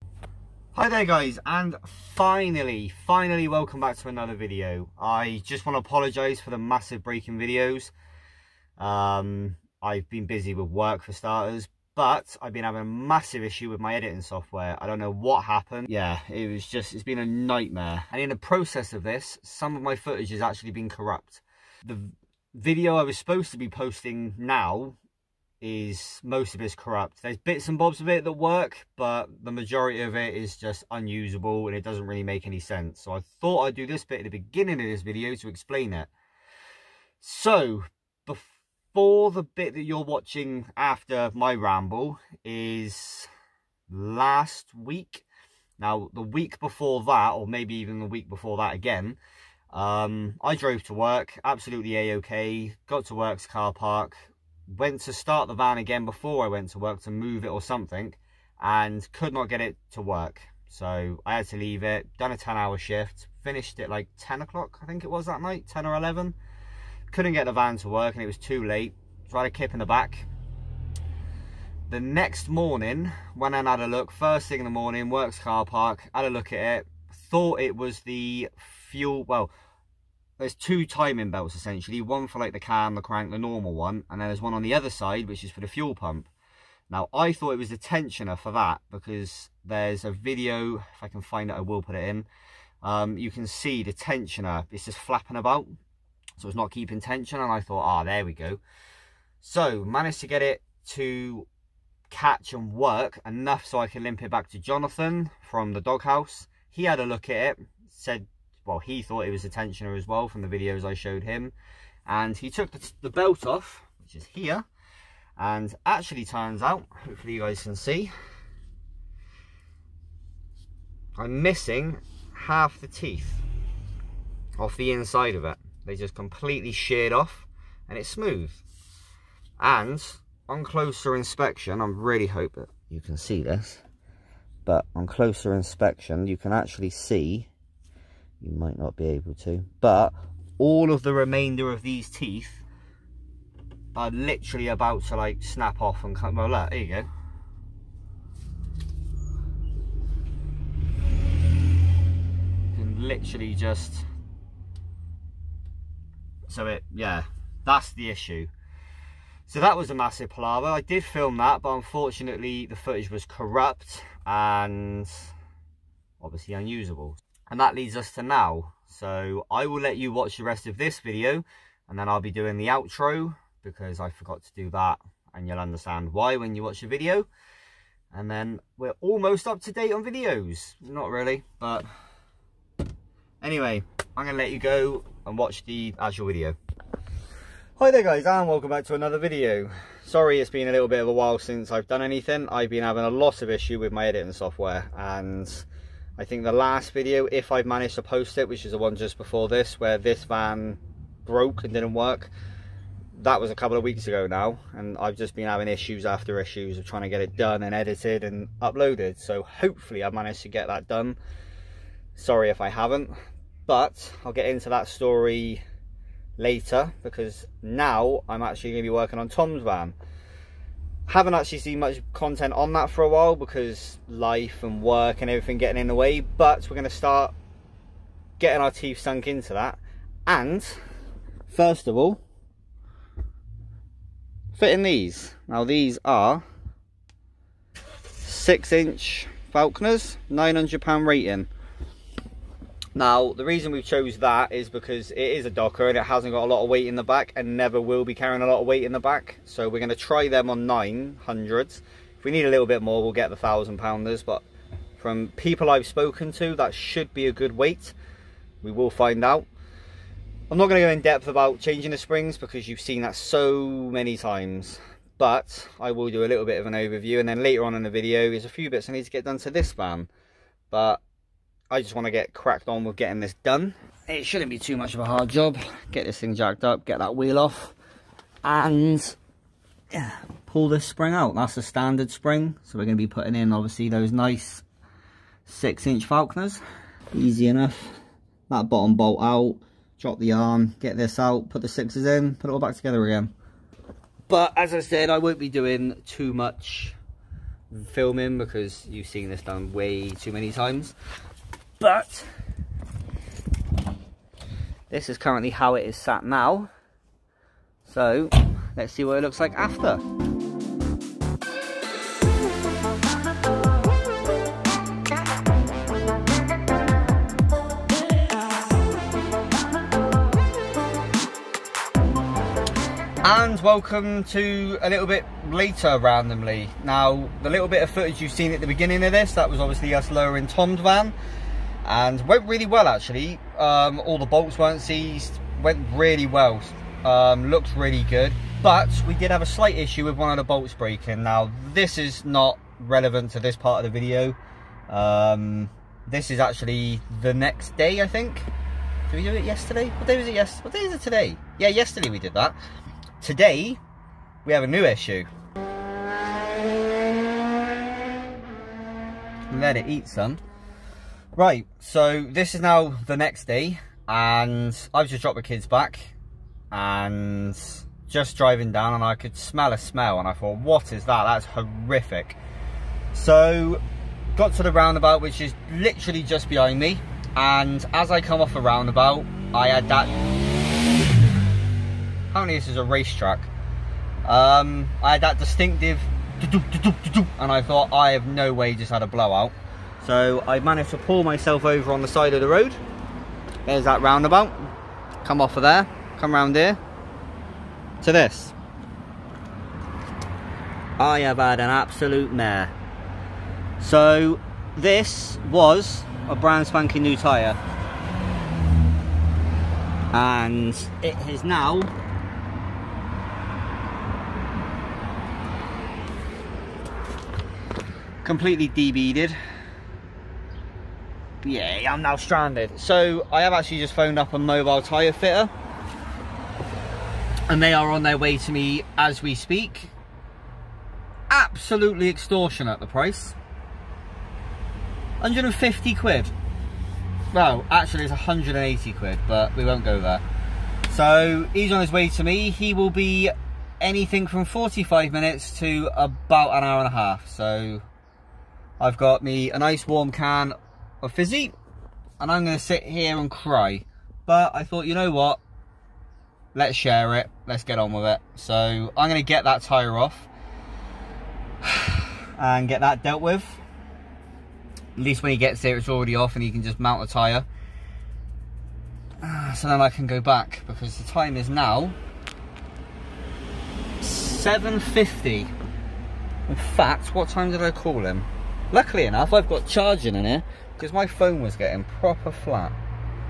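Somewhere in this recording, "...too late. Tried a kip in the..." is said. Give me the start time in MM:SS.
01:08.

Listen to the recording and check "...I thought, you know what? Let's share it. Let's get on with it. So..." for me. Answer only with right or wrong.
right.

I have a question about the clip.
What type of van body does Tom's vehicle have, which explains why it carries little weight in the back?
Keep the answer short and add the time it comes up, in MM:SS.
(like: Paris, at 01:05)
Doka, at 04:05.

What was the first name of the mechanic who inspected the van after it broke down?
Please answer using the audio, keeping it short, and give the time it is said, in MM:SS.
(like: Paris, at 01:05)
Jonathan, at 01:44.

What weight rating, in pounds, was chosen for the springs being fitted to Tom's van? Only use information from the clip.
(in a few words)
900.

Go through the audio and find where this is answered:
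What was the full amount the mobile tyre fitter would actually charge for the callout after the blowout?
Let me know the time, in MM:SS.
07:18.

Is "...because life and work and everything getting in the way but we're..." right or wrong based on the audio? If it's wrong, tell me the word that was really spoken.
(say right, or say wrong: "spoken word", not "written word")
right.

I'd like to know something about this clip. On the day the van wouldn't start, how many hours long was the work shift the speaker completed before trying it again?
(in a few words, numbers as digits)
10 hour.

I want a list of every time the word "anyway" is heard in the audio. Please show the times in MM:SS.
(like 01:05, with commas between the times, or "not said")
03:03.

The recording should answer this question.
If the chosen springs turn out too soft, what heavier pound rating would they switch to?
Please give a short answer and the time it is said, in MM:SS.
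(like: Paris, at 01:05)
1,000, at 04:13.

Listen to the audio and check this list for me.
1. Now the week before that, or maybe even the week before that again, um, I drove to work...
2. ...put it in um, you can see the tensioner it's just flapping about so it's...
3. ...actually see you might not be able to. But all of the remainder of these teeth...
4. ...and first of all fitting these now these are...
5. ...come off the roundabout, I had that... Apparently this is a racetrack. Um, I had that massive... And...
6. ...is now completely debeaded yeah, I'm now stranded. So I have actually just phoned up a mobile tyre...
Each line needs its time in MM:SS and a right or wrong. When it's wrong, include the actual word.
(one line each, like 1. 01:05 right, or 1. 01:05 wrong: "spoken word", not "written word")
1. 00:45 right
2. 01:31 right
3. 02:16 right
4. 03:50 right
5. 06:18 wrong: "distinctive", not "massive"
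6. 06:51 right.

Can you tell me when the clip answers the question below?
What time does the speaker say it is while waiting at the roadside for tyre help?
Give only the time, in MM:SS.
07:54.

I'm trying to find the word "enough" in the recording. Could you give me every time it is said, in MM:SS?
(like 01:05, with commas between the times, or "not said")
01:43, 04:47, 07:59.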